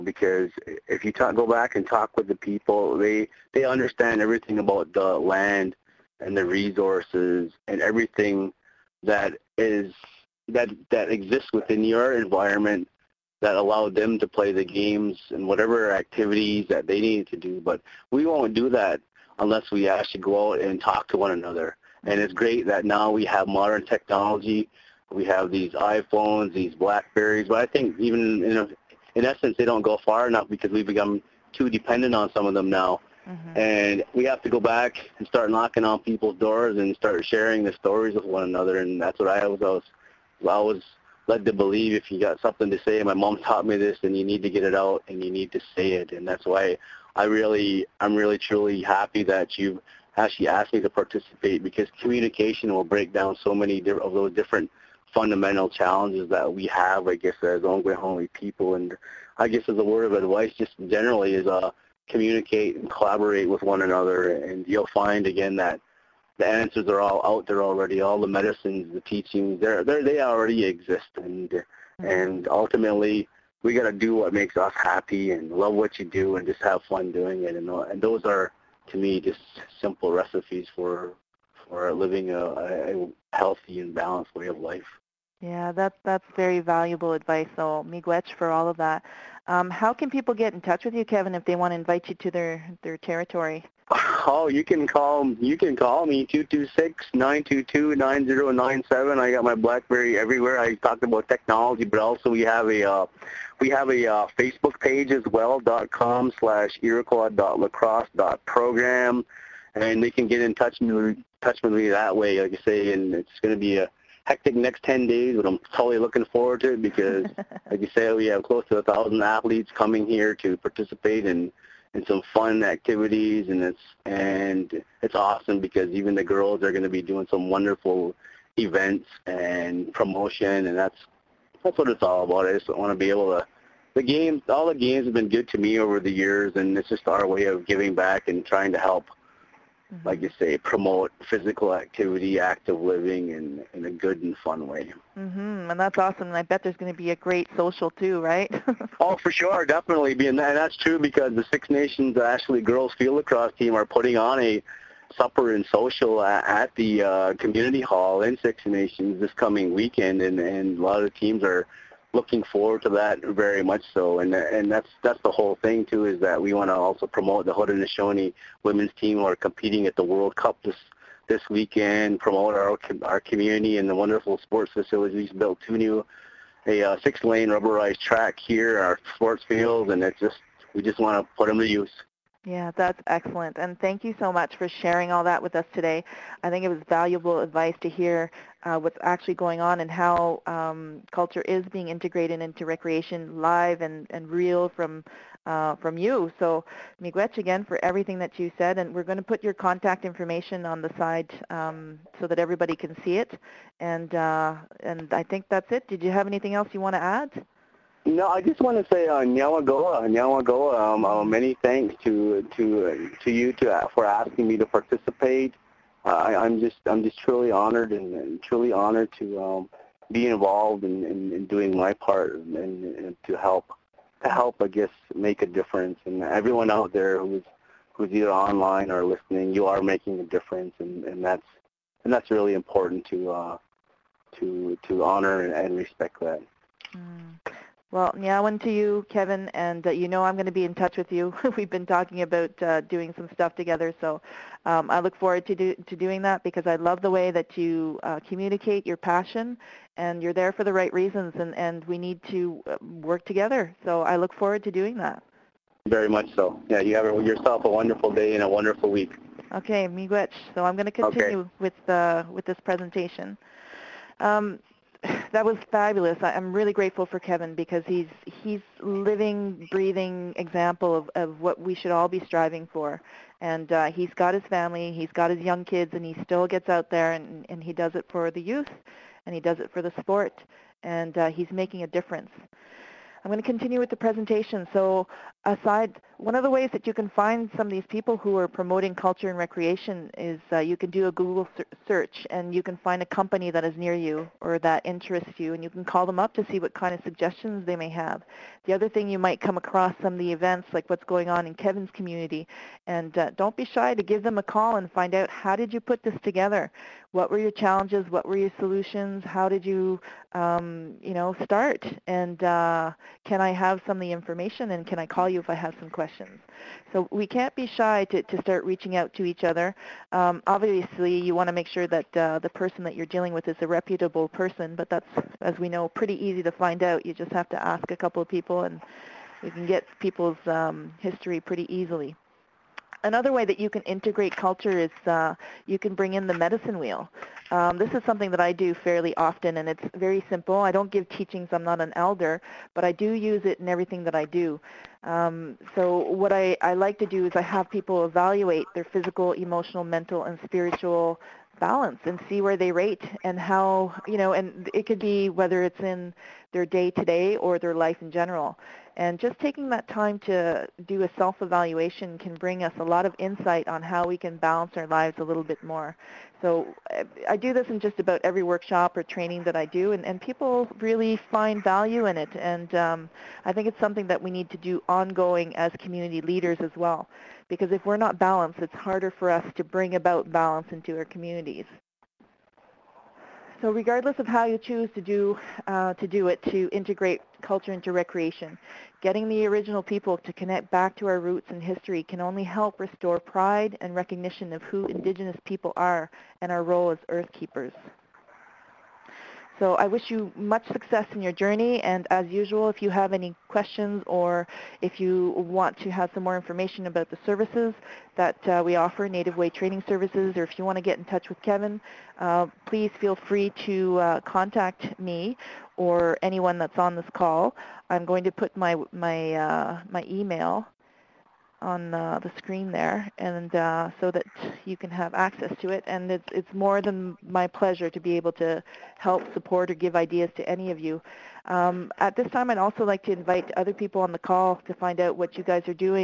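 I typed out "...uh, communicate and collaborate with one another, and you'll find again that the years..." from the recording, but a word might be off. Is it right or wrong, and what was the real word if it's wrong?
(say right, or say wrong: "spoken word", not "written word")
wrong: "answers", not "years".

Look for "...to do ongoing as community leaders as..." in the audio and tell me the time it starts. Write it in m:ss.
6:14.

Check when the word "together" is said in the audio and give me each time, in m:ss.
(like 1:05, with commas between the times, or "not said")
4:03, 4:13, 5:06.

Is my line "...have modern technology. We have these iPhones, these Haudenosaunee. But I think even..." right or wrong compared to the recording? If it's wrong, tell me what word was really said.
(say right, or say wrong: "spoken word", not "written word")
wrong: "Blackberries", not "Haudenosaunee".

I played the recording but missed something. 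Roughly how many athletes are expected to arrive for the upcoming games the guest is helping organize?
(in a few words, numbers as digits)
1000.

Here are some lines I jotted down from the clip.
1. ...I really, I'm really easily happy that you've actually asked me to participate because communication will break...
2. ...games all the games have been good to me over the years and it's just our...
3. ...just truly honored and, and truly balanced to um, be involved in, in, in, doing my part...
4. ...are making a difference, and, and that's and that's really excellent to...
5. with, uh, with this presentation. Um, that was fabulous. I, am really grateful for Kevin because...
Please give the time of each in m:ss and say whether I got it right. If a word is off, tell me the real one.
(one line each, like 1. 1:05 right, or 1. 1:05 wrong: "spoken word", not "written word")
1. 0:47 wrong: "truly", not "easily"
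2. 2:14 right
3. 3:37 wrong: "honored", not "balanced"
4. 3:49 wrong: "important", not "excellent"
5. 4:21 right.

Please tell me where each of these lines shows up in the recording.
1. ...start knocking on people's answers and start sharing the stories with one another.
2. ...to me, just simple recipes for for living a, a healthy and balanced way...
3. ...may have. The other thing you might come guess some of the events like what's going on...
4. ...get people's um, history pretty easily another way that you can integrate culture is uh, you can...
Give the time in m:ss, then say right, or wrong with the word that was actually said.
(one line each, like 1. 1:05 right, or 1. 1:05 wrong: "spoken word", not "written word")
1. 0:35 wrong: "doors", not "answers"
2. 1:18 right
3. 4:57 wrong: "across", not "guess"
4. 5:29 right.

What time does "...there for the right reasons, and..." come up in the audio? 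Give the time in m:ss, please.
4:10.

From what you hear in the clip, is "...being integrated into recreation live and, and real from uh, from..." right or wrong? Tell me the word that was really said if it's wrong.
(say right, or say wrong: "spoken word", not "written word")
right.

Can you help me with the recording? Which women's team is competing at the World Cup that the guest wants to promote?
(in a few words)
Haudenosaunee women's team.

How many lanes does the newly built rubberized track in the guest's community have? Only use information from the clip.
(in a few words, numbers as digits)
6.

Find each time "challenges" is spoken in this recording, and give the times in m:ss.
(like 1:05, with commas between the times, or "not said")
0:55, 5:07.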